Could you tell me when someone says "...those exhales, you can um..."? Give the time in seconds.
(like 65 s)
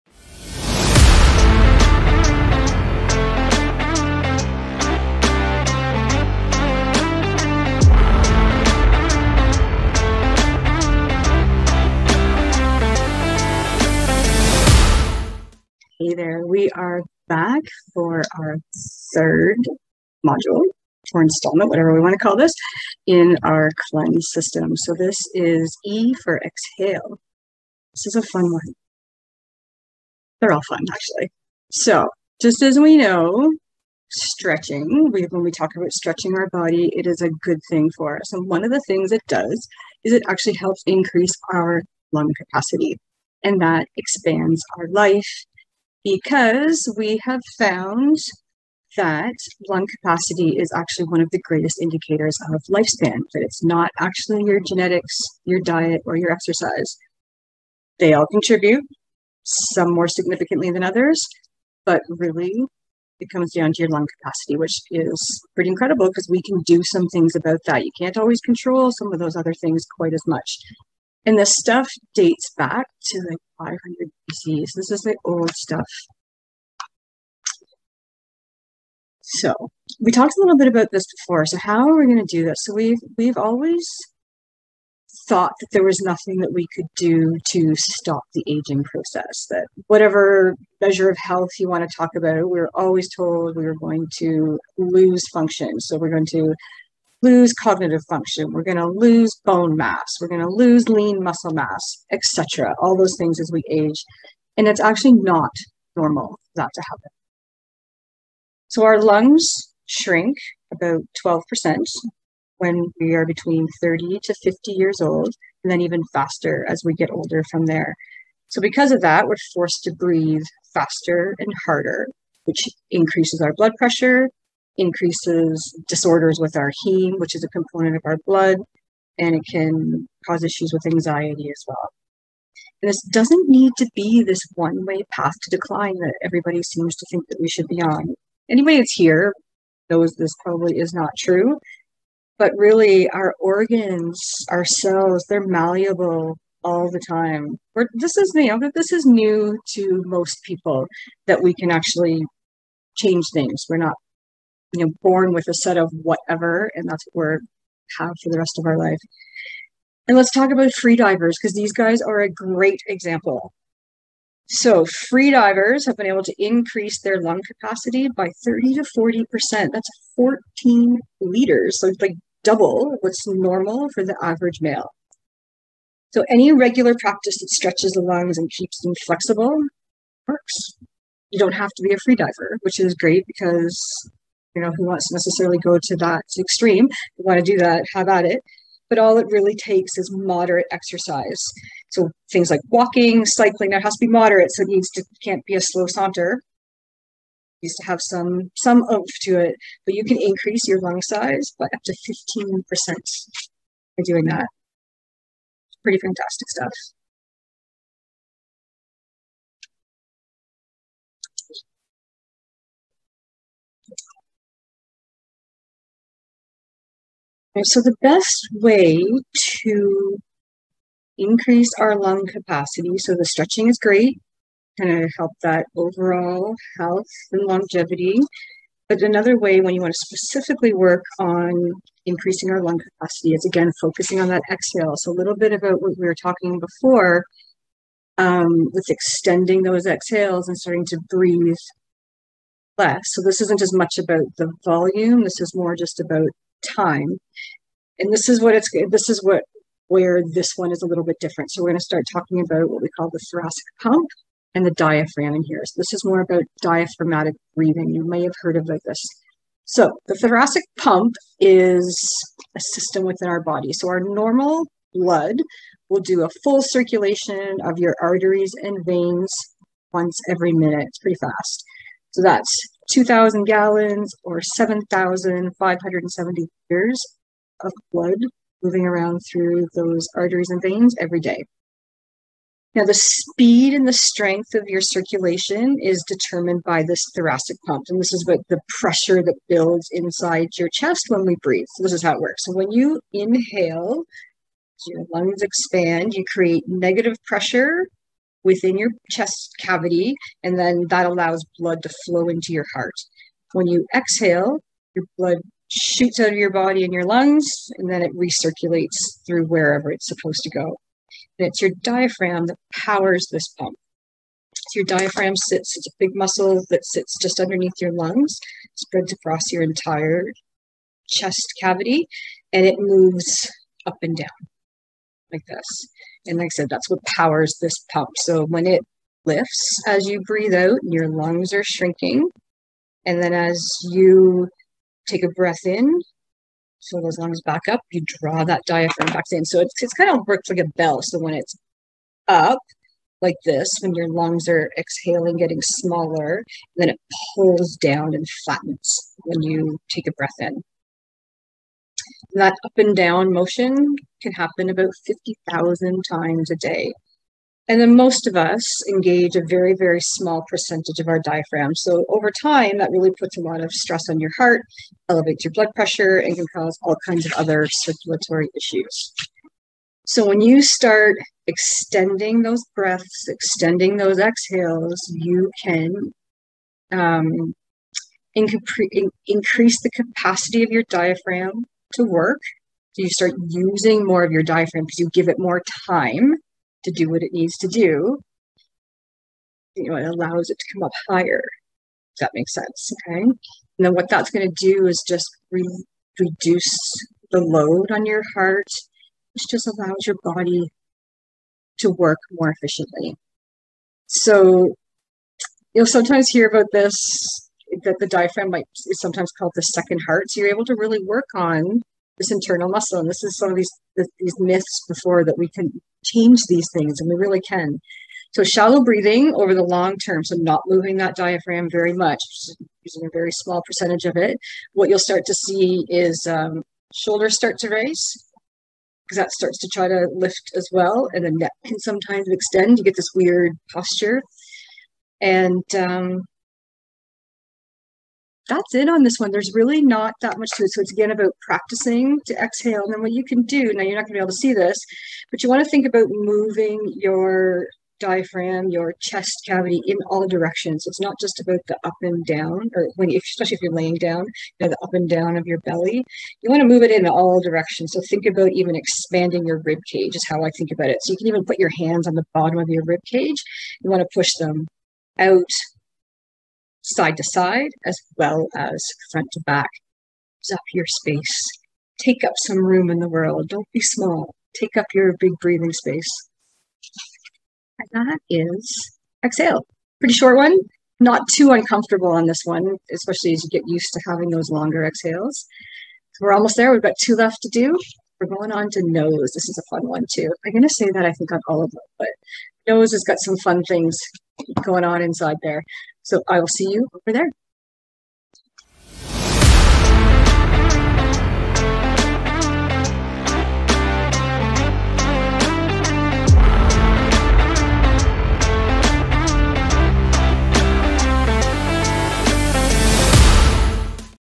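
373 s.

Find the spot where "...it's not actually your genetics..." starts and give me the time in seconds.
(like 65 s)
53 s.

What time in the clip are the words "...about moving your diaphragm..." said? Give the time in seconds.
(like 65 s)
445 s.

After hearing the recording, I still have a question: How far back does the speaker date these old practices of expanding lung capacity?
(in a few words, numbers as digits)
500 BC.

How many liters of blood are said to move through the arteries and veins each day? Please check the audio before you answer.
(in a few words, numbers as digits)
7,570 liters.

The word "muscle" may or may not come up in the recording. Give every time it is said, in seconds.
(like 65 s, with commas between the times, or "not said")
101 s, 316 s, 412 s.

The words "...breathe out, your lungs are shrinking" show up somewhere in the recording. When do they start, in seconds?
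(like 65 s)
330 s.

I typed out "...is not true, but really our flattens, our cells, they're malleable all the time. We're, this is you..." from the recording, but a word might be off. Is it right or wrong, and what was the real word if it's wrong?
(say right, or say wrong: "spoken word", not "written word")
wrong: "organs", not "flattens".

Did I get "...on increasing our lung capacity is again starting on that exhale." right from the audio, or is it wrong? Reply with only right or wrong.
wrong.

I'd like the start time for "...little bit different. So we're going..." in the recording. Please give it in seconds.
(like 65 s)
250 s.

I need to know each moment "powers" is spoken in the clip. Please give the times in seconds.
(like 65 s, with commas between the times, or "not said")
312 s, 327 s.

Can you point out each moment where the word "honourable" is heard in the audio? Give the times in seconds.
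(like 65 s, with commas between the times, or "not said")
not said.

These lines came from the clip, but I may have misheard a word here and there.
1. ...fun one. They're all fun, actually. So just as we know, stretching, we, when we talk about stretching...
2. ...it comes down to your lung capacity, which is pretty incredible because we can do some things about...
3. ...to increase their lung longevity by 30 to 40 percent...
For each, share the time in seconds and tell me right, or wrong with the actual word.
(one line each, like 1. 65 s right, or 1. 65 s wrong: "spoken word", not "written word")
1. 28 s right
2. 63 s right
3. 166 s wrong: "capacity", not "longevity".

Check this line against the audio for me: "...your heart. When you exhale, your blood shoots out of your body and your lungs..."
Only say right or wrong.
right.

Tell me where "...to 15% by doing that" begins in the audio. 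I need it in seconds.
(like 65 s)
201 s.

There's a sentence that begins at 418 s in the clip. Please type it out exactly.
So shallow breathing over the long term, so not moving that diaphragm very much, using a very small percentage of it.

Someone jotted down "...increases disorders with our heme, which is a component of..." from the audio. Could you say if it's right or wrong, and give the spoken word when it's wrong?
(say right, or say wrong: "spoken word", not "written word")
right.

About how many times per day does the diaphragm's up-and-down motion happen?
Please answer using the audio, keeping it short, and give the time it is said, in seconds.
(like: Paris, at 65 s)
50,000, at 355 s.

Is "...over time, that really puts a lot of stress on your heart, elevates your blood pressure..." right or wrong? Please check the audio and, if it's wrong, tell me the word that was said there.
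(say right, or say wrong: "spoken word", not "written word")
right.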